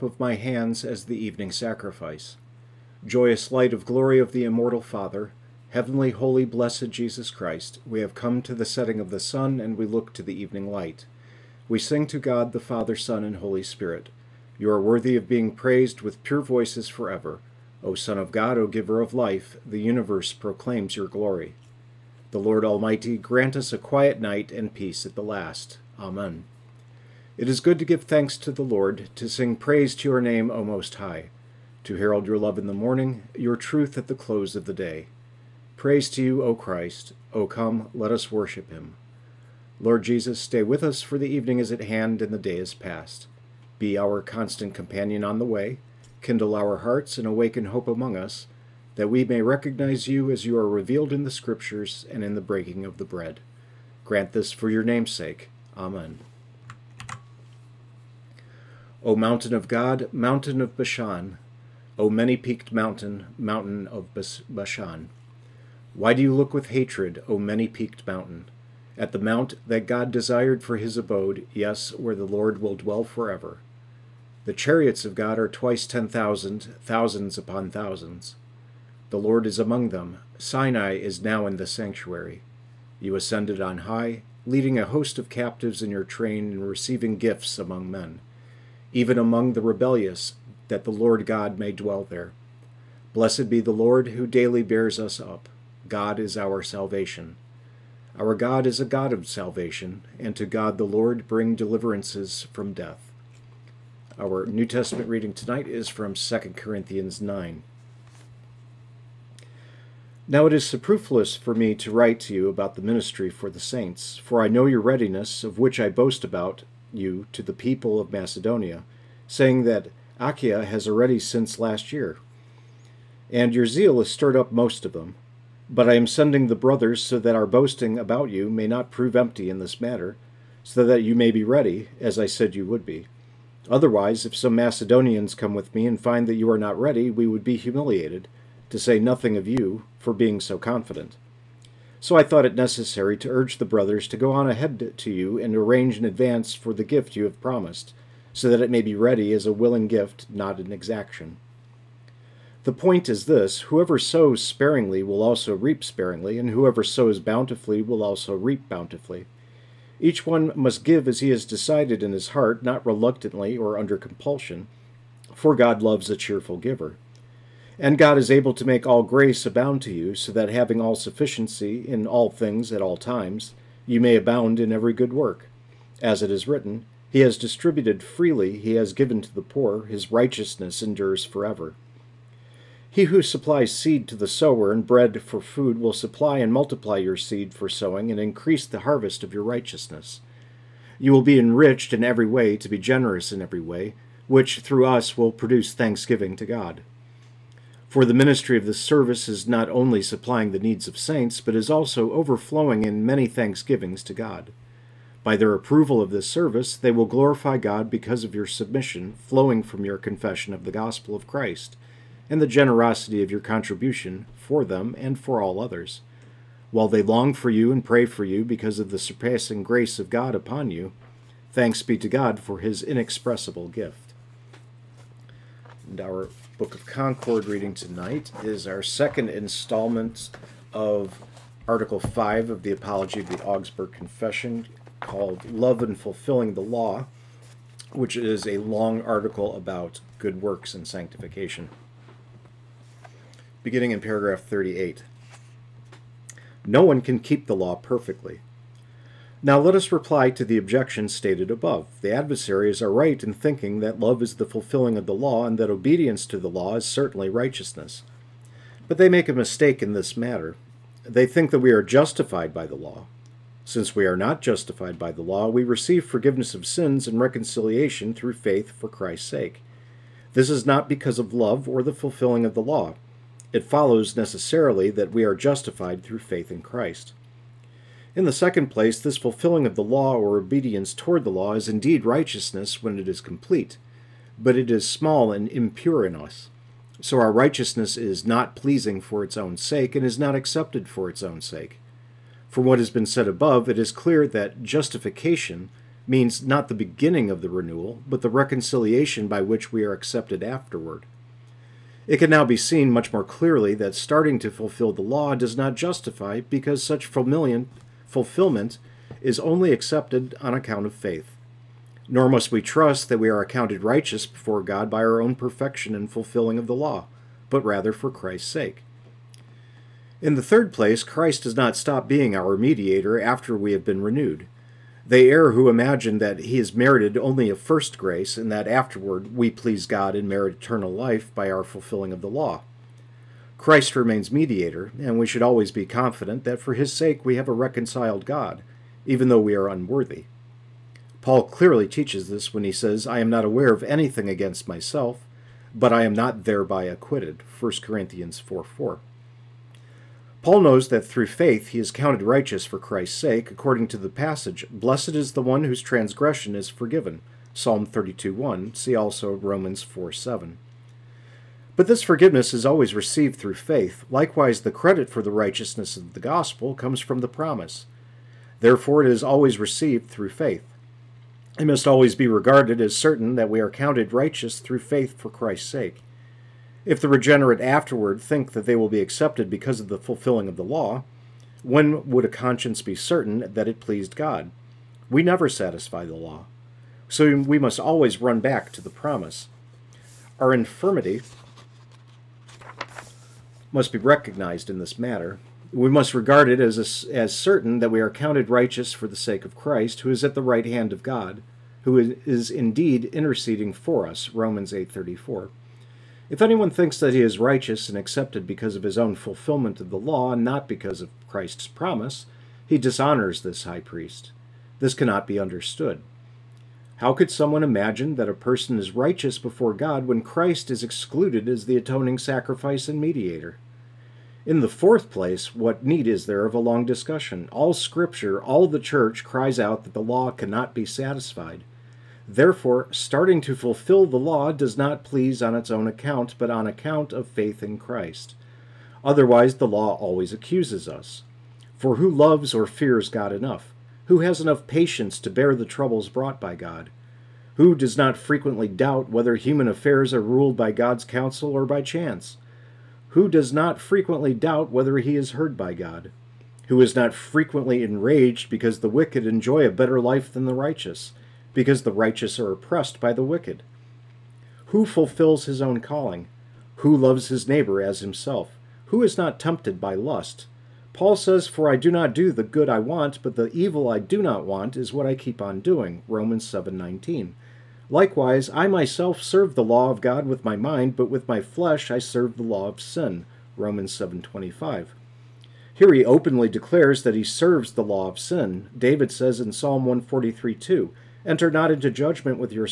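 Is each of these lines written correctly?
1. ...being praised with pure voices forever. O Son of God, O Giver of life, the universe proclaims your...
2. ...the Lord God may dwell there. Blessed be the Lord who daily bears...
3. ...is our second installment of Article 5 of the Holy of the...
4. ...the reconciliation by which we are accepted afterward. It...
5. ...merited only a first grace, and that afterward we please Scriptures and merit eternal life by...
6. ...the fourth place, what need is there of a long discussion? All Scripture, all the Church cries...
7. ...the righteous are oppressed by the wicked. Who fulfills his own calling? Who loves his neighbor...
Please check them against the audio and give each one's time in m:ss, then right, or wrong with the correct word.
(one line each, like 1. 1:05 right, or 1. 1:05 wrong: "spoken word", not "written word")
1. 0:15 right
2. 1:30 right
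3. 3:48 wrong: "Apology", not "Holy"
4. 4:58 right
5. 5:26 wrong: "God", not "Scriptures"
6. 7:04 right
7. 7:41 right.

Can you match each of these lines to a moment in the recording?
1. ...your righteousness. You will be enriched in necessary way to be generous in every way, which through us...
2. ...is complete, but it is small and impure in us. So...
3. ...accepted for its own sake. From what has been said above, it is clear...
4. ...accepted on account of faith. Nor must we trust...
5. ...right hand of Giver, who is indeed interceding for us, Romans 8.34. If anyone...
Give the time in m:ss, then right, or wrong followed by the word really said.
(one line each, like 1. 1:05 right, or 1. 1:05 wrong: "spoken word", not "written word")
1. 3:09 wrong: "every", not "necessary"
2. 4:43 right
3. 4:50 right
4. 5:09 right
5. 6:40 wrong: "God", not "Giver".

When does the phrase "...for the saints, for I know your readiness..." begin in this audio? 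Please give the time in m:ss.
1:53.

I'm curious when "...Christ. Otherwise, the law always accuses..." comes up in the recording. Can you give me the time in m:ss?
7:17.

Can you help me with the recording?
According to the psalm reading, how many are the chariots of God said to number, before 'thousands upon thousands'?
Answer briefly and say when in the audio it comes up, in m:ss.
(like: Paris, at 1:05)
Twice ten thousand, at 1:15.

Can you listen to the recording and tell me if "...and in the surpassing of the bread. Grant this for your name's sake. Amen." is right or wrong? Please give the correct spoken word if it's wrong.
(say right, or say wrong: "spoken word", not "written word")
wrong: "breaking", not "surpassing".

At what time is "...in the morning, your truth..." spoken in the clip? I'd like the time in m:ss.
0:32.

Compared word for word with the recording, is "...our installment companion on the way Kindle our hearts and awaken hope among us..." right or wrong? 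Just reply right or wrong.
wrong.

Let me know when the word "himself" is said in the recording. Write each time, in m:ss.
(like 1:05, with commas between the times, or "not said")
7:47.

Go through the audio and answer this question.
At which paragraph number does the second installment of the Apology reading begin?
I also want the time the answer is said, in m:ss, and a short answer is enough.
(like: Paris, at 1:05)
38, at 4:03.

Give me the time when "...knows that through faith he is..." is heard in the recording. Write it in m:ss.
5:50.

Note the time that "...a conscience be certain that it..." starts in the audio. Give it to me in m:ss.
6:22.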